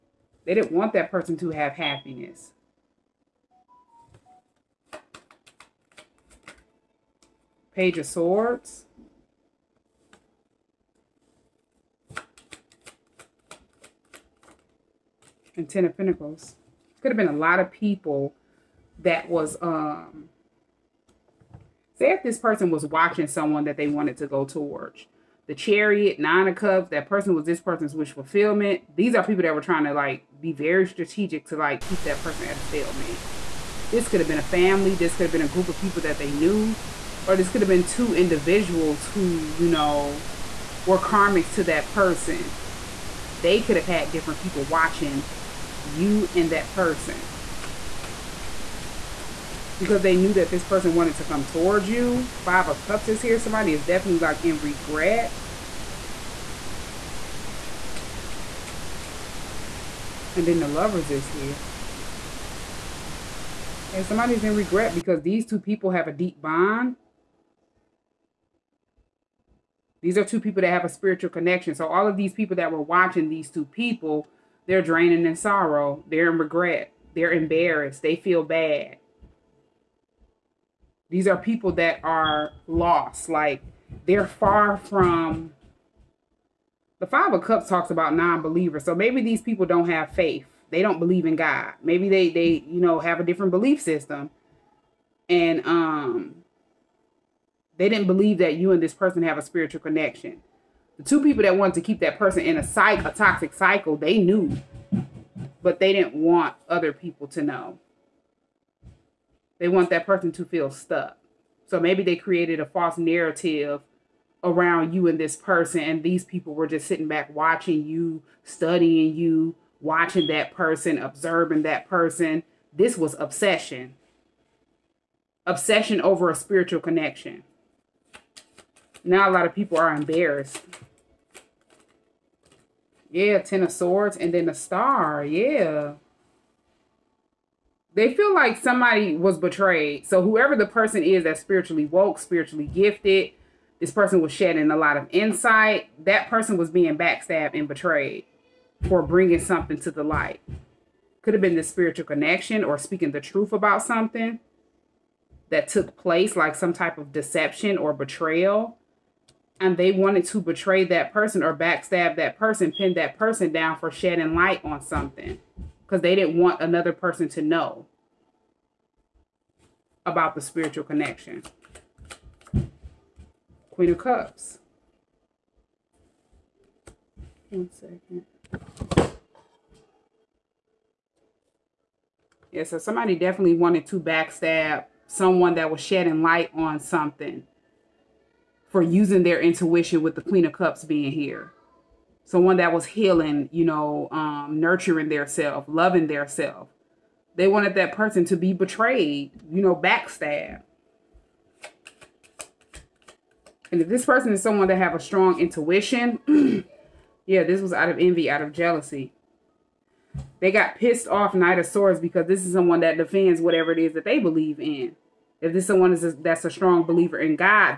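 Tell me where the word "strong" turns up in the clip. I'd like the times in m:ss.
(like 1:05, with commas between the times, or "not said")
3:24, 3:36.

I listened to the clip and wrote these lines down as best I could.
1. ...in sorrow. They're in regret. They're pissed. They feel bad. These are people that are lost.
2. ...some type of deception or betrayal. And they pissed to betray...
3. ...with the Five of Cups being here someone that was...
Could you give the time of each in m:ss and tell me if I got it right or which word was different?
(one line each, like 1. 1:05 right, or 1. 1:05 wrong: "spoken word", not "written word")
1. 1:15 wrong: "embarrassed", not "pissed"
2. 2:36 wrong: "wanted", not "pissed"
3. 3:10 wrong: "Queen", not "Five".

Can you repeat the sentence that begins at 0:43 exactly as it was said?
They could have had different people watching you and that person because they knew that this person wanted to come towards you.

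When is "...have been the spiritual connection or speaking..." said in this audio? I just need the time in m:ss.
2:31.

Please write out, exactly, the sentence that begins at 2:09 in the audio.
Now a lot of people are embarrassed.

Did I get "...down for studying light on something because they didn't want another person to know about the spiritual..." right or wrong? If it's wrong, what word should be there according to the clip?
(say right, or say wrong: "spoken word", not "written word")
wrong: "shedding", not "studying".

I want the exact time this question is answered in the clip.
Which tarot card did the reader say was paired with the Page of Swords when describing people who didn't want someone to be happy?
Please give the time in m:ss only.
0:15.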